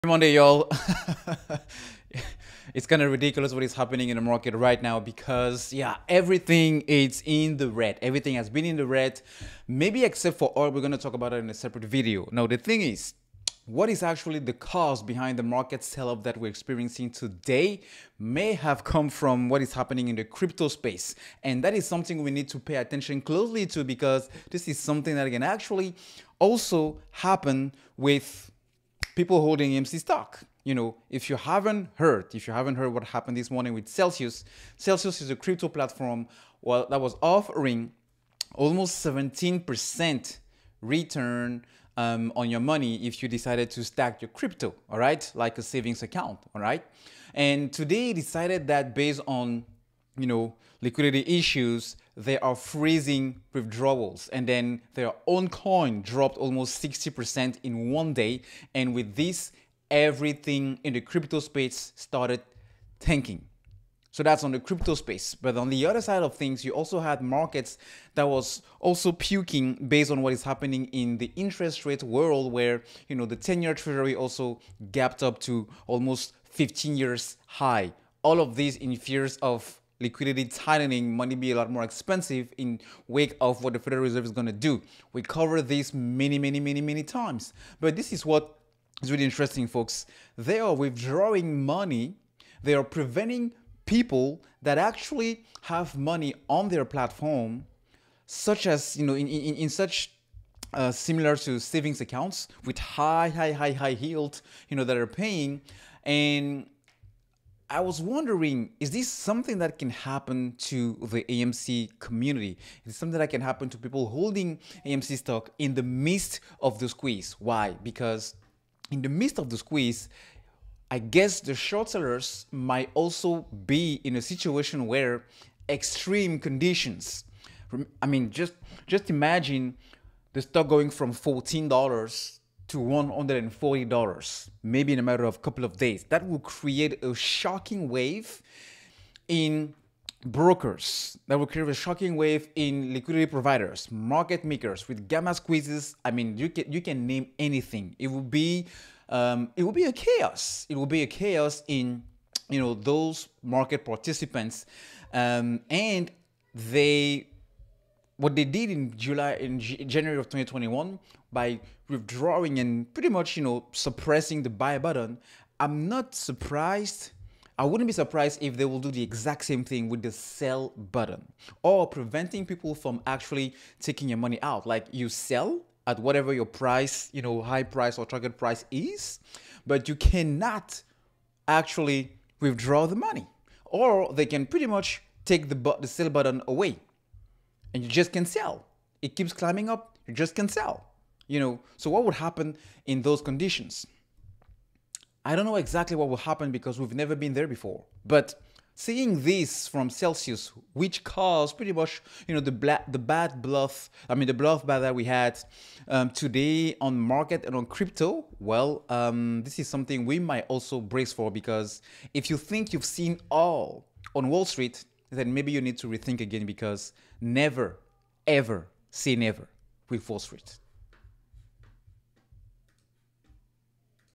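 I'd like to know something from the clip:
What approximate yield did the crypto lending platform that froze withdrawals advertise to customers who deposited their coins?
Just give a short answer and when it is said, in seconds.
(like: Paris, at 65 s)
17%, at 38 s.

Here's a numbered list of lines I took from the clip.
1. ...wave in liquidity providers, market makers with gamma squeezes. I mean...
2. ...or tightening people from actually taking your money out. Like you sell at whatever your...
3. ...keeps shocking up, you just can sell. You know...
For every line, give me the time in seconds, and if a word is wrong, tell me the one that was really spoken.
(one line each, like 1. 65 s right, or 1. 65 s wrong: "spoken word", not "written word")
1. 142 s right
2. 171 s wrong: "preventing", not "tightening"
3. 189 s wrong: "climbing", not "shocking".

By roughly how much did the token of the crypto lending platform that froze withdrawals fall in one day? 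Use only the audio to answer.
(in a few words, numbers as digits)
60%.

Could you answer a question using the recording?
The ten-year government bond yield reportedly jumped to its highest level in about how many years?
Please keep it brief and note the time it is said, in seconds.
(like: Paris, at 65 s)
15 years, at 76 s.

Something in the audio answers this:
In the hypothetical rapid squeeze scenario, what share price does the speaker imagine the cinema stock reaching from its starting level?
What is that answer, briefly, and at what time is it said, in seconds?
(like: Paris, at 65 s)
$140, at 132 s.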